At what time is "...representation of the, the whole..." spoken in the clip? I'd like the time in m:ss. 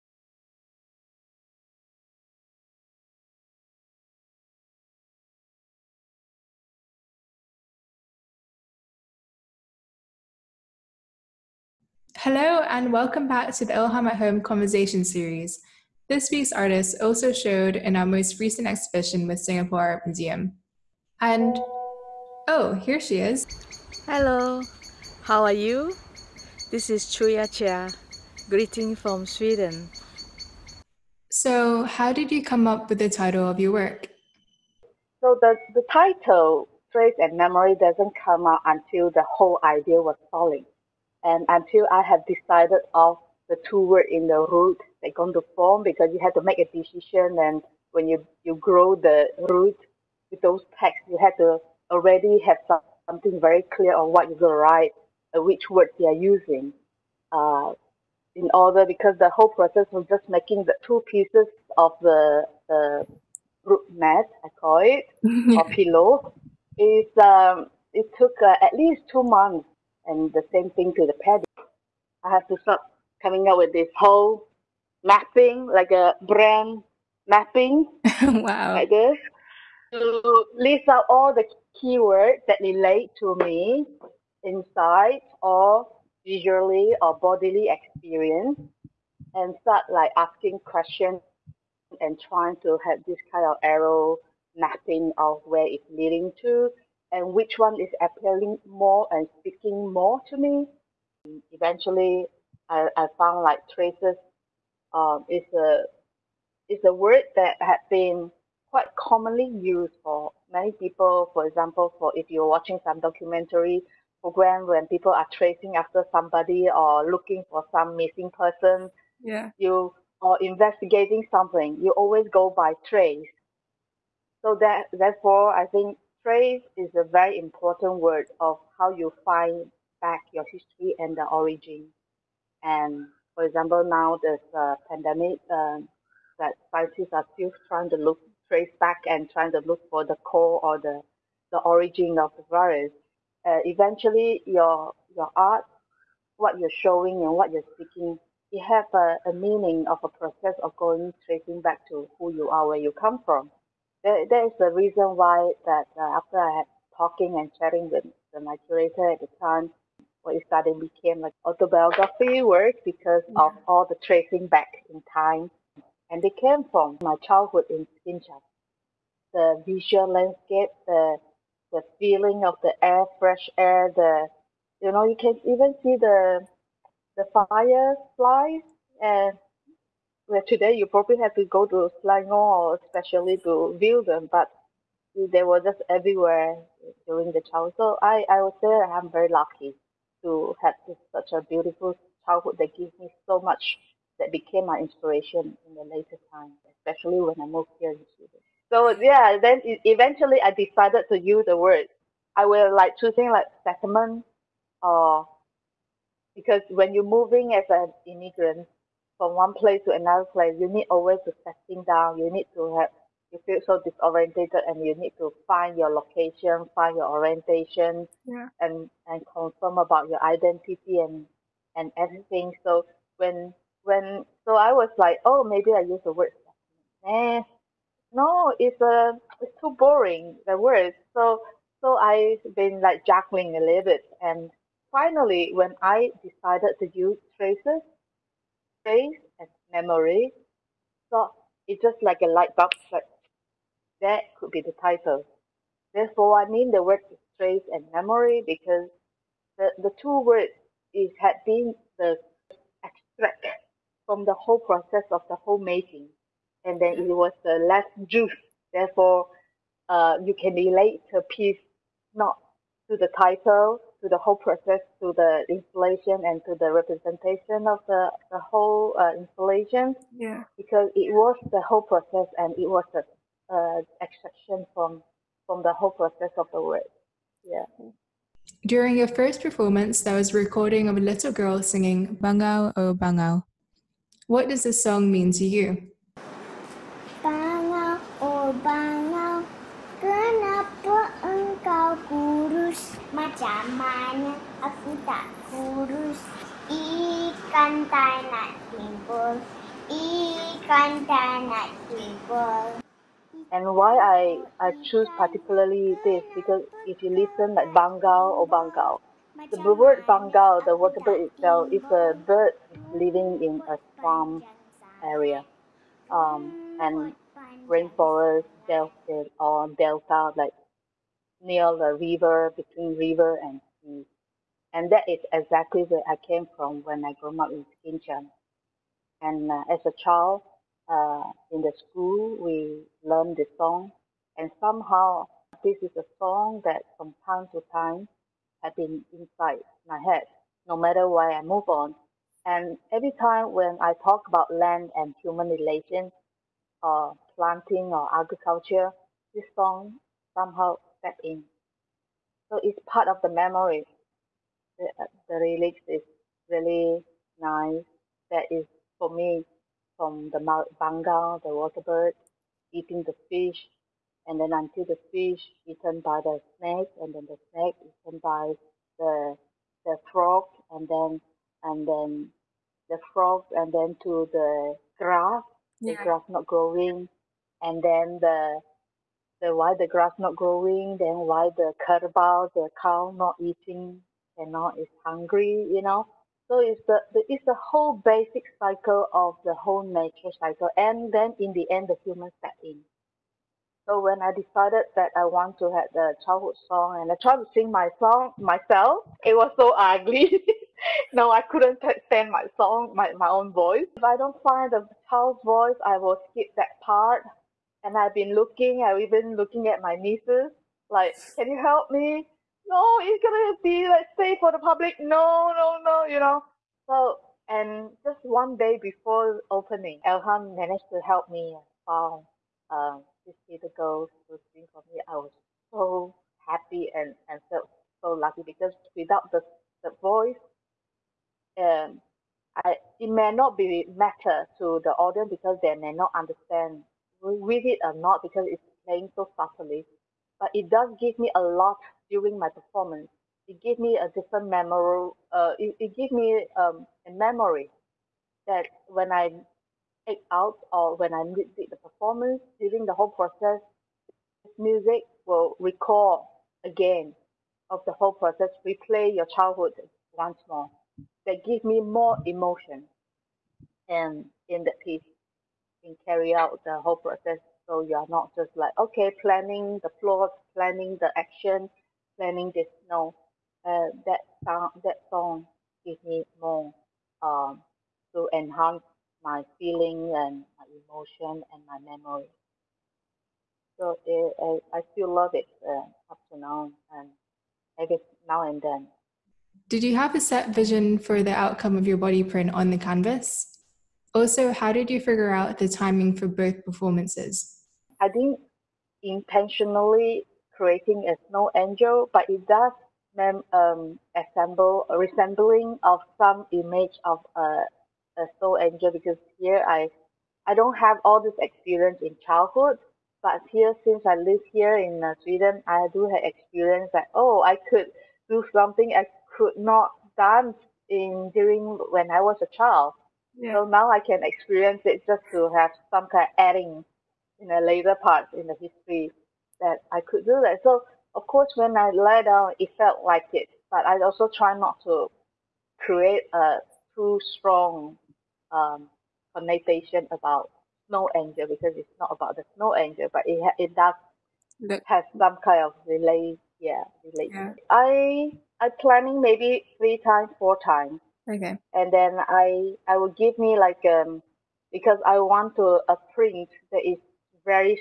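4:26.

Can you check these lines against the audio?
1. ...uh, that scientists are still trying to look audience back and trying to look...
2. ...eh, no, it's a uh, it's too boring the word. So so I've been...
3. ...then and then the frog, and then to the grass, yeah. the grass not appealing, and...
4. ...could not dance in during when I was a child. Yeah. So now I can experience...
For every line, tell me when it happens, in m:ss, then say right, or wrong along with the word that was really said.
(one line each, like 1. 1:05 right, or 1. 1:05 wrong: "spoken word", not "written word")
1. 2:15 wrong: "trace", not "audience"
2. 3:47 right
3. 6:10 wrong: "growing", not "appealing"
4. 8:39 right.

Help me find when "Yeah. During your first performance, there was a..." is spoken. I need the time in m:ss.
4:37.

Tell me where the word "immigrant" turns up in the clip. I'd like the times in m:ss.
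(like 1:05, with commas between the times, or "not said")
3:28.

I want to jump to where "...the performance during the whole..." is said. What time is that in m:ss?
7:31.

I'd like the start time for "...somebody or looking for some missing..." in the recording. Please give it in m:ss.
1:56.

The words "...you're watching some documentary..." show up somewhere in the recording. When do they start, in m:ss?
1:52.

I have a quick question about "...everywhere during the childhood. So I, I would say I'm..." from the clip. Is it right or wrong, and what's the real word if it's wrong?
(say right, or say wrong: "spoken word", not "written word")
right.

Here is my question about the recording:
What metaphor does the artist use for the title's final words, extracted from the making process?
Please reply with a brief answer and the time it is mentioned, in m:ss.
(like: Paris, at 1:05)
The last juice, at 4:17.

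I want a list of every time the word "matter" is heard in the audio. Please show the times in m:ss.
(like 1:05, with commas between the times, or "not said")
5:40, 7:13.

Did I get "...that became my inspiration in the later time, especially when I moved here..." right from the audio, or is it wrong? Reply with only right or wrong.
right.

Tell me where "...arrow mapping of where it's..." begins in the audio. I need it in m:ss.
1:33.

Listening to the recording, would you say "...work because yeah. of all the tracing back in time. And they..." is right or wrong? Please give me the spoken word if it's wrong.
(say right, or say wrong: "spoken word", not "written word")
right.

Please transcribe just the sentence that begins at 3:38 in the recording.
and and confirm about your identity and and everything.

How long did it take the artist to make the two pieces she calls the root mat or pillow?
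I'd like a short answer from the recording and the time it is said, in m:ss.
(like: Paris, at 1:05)
At least two months, at 1:08.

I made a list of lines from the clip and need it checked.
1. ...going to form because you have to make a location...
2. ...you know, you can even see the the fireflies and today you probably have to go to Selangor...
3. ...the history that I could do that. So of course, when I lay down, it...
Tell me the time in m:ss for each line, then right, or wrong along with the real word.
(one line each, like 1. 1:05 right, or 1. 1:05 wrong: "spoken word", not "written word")
1. 0:45 wrong: "decision", not "location"
2. 2:54 right
3. 8:48 right.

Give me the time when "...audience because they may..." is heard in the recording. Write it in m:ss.
7:14.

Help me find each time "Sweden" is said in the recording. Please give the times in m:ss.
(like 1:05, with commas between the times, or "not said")
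0:29, 3:18, 8:35.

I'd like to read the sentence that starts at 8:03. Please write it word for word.
So it, uh, I, I still love it uh, up to now and I guess now and then.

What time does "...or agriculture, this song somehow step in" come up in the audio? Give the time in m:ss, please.
5:47.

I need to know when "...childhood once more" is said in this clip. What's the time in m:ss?
7:39.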